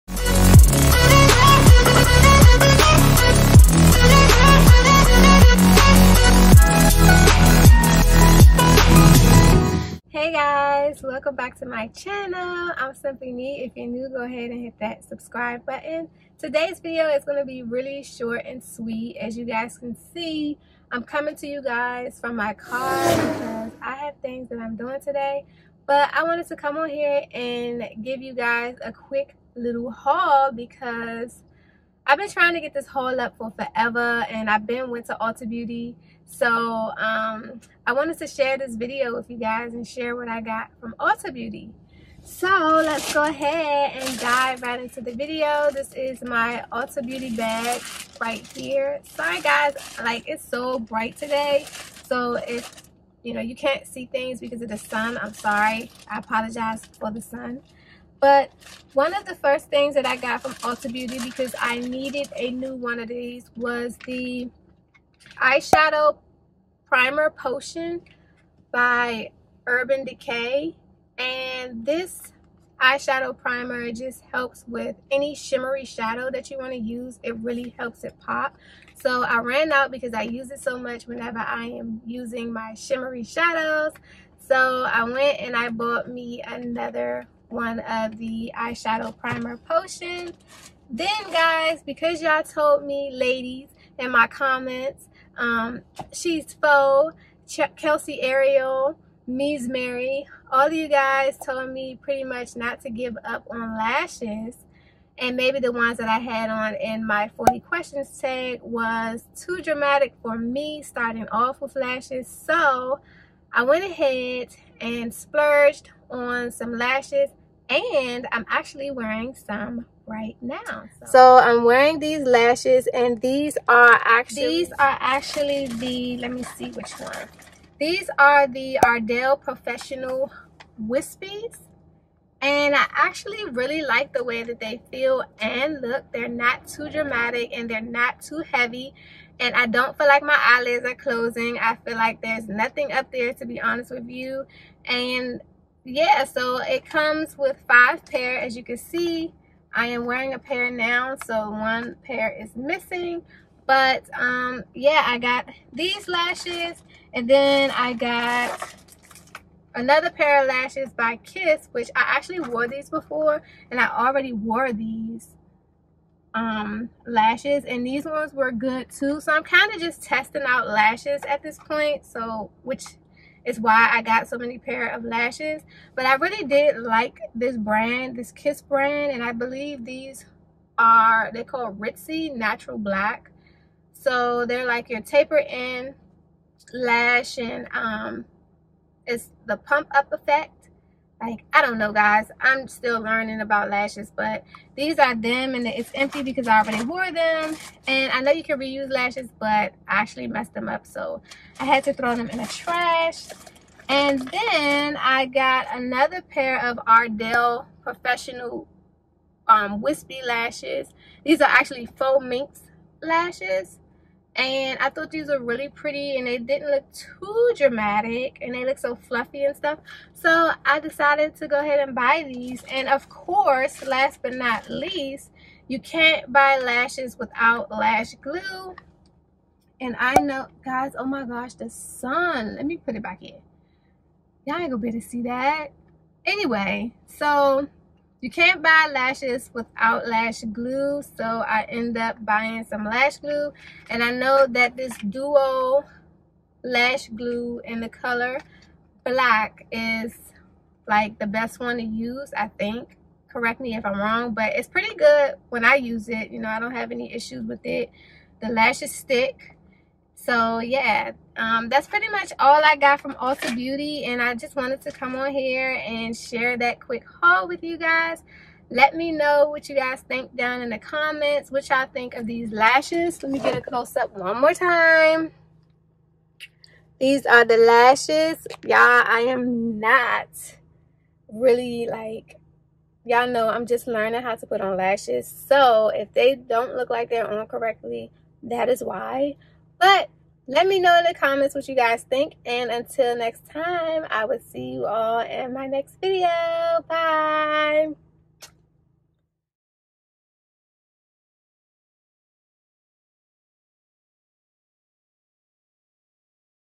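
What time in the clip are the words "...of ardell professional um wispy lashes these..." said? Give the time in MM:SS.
03:26.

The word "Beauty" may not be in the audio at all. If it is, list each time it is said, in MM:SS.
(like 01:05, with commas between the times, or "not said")
00:35, 00:41, 00:47, 01:00, 04:23.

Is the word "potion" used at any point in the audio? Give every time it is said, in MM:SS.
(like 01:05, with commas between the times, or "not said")
01:07, 01:29.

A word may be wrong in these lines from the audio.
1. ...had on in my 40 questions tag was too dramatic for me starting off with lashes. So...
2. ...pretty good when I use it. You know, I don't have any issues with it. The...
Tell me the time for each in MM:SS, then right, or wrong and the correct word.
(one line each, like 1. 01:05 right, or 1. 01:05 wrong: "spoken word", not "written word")
1. 01:46 right
2. 04:14 right.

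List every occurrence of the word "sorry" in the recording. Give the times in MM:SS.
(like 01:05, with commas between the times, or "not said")
00:49, 00:55.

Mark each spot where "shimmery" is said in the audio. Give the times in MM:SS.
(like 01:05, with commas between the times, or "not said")
01:15, 01:22.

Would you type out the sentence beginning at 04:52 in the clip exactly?
And until next time, I will see you all in my next video.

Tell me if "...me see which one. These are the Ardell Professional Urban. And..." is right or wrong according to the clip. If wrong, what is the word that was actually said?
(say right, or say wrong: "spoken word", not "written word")
wrong: "Wispies", not "Urban".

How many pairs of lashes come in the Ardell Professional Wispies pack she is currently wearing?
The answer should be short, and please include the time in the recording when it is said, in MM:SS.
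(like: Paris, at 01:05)
5, at 02:27.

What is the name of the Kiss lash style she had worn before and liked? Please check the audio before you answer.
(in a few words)
Ritzy Natural Black.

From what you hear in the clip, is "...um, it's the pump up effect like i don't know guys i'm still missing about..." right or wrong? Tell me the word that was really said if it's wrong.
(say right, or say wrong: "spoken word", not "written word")
wrong: "learning", not "missing".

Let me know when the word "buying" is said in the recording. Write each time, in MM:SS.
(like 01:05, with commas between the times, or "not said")
04:02.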